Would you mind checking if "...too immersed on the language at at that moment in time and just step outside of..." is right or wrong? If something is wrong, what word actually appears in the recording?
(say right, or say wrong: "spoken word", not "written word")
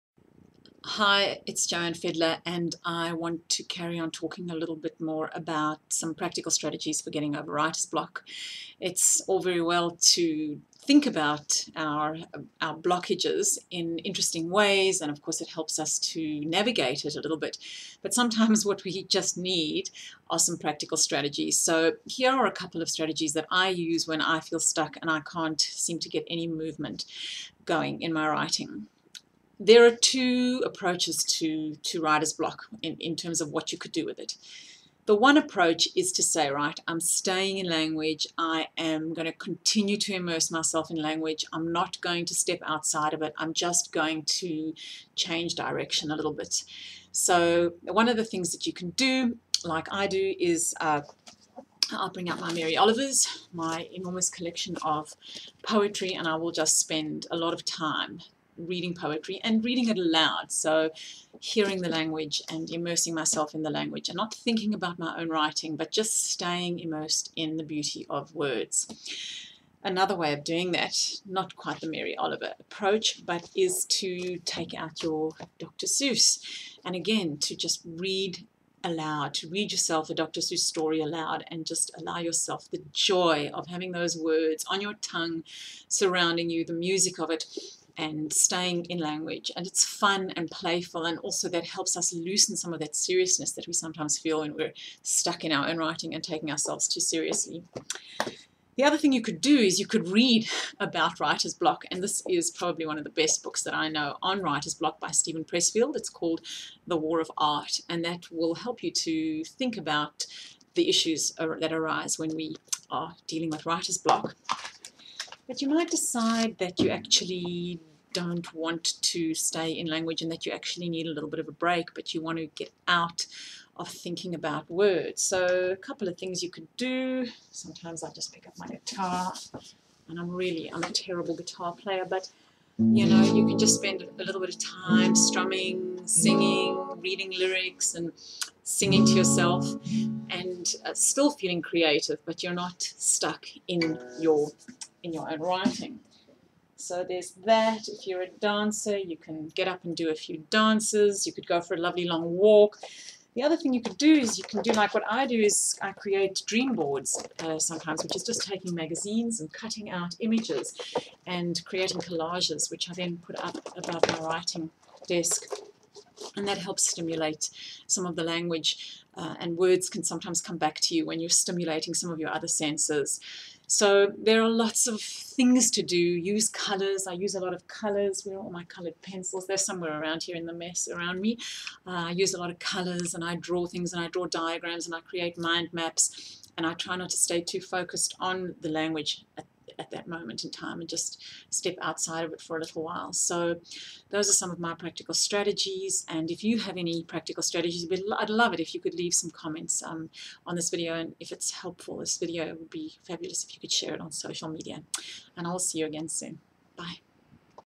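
wrong: "focused", not "immersed".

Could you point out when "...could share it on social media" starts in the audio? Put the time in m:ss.
3:23.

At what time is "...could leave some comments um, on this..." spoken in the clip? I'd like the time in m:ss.
3:18.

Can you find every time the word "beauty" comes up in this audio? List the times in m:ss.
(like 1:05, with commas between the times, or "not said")
1:07.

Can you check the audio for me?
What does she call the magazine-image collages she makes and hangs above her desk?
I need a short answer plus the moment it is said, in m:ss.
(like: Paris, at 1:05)
Dream boards, at 2:36.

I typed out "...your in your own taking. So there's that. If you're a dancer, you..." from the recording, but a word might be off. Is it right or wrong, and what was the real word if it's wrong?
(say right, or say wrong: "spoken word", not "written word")
wrong: "writing", not "taking".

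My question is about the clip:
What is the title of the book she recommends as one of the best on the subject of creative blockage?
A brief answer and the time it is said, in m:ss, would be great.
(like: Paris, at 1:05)
The War of Art, at 1:46.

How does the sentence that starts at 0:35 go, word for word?
The one approach is to say, right, I'm staying in language.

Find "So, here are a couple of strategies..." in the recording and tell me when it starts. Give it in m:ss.
0:21.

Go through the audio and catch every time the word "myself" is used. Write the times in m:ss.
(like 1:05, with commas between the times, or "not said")
0:40, 1:03.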